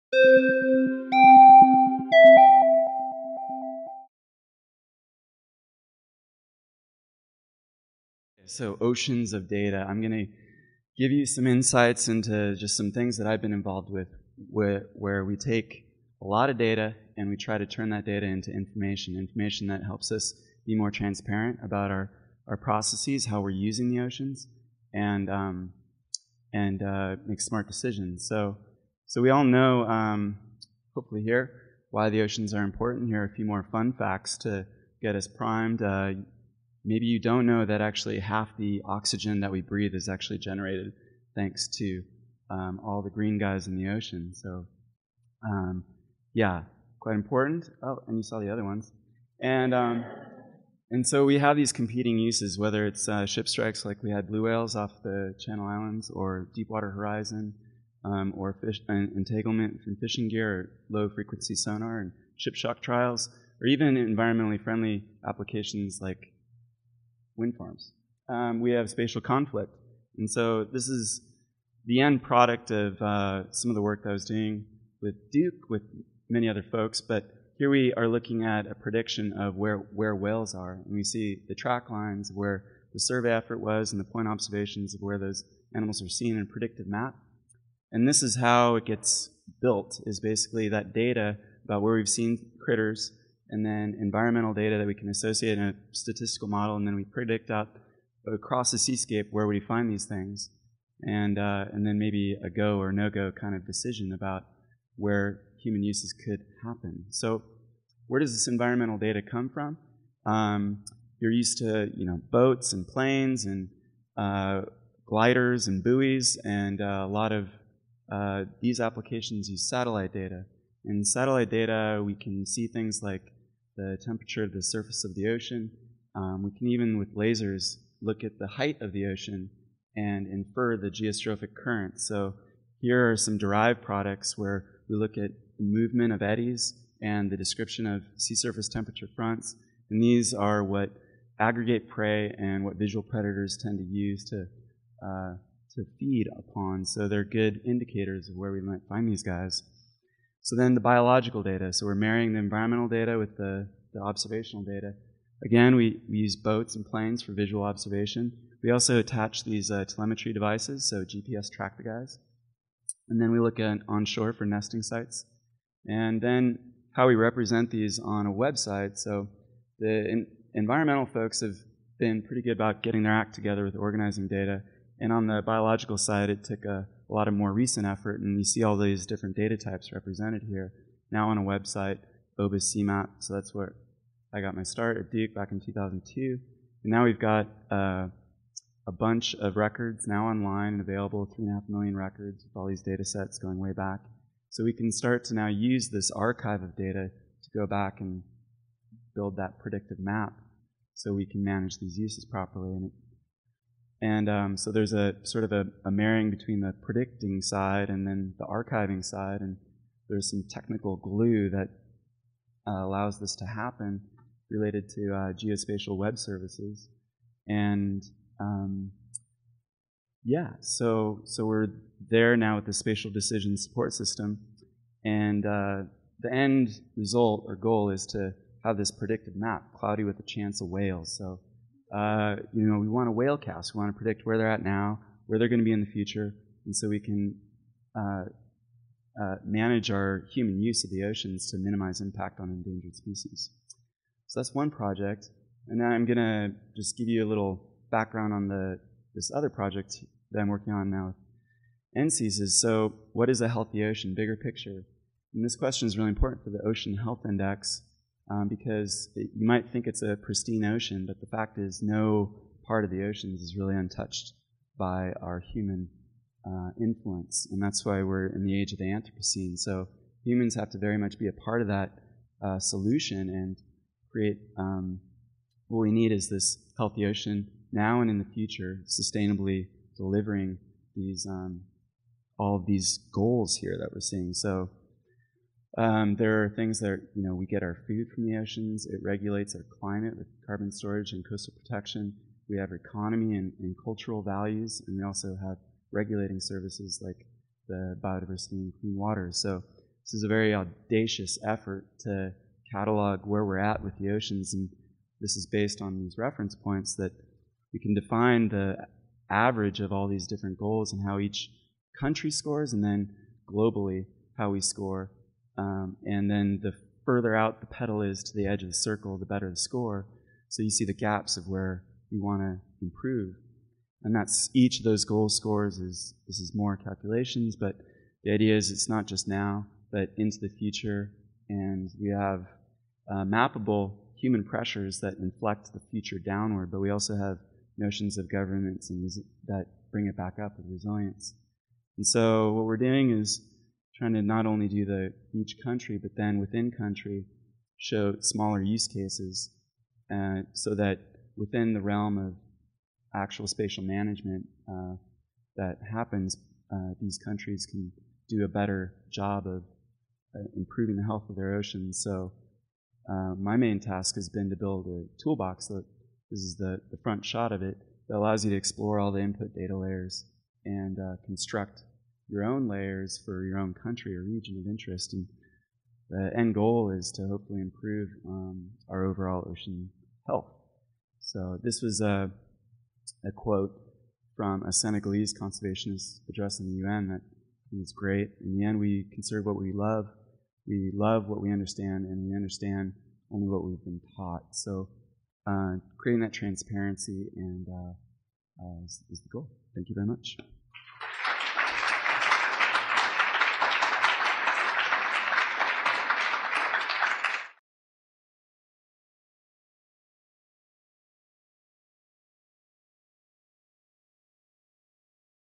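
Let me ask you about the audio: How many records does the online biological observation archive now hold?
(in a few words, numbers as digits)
3.5 million.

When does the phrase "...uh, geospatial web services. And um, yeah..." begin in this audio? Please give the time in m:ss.
3:35.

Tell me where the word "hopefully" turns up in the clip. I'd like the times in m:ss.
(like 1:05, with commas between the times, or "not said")
0:30, 6:17.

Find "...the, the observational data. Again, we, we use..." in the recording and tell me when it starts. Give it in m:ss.
2:33.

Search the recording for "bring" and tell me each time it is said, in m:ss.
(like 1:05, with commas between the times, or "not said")
5:39.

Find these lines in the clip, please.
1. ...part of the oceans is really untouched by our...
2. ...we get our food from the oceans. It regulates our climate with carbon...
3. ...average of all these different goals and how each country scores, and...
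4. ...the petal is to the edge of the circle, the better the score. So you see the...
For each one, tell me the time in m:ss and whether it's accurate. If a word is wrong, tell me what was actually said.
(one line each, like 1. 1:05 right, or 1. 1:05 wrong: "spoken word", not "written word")
1. 4:22 right
2. 4:47 right
3. 5:09 right
4. 5:17 right.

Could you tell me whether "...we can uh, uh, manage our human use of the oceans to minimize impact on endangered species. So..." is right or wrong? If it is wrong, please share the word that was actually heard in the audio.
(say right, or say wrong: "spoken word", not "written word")
right.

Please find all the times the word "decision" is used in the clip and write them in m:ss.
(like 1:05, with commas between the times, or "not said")
0:27, 1:43, 3:43.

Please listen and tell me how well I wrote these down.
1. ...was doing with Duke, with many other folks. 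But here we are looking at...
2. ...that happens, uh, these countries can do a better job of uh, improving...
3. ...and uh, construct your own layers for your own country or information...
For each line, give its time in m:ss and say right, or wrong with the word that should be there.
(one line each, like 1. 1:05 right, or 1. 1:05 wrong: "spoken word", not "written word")
1. 1:14 right
2. 5:55 right
3. 6:10 wrong: "region", not "information".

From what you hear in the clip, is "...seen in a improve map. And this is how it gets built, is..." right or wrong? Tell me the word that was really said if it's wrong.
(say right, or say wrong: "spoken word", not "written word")
wrong: "predictive", not "improve".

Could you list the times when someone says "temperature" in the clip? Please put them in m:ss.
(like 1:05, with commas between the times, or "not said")
2:04, 2:18.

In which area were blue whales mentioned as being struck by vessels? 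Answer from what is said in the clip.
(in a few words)
Channel Islands.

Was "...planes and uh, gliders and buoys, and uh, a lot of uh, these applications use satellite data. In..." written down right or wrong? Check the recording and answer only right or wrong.
right.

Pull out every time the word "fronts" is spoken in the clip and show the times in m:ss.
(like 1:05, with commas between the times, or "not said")
2:19, 6:07.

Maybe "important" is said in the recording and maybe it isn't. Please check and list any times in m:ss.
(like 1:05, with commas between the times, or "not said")
0:32, 0:47, 4:16.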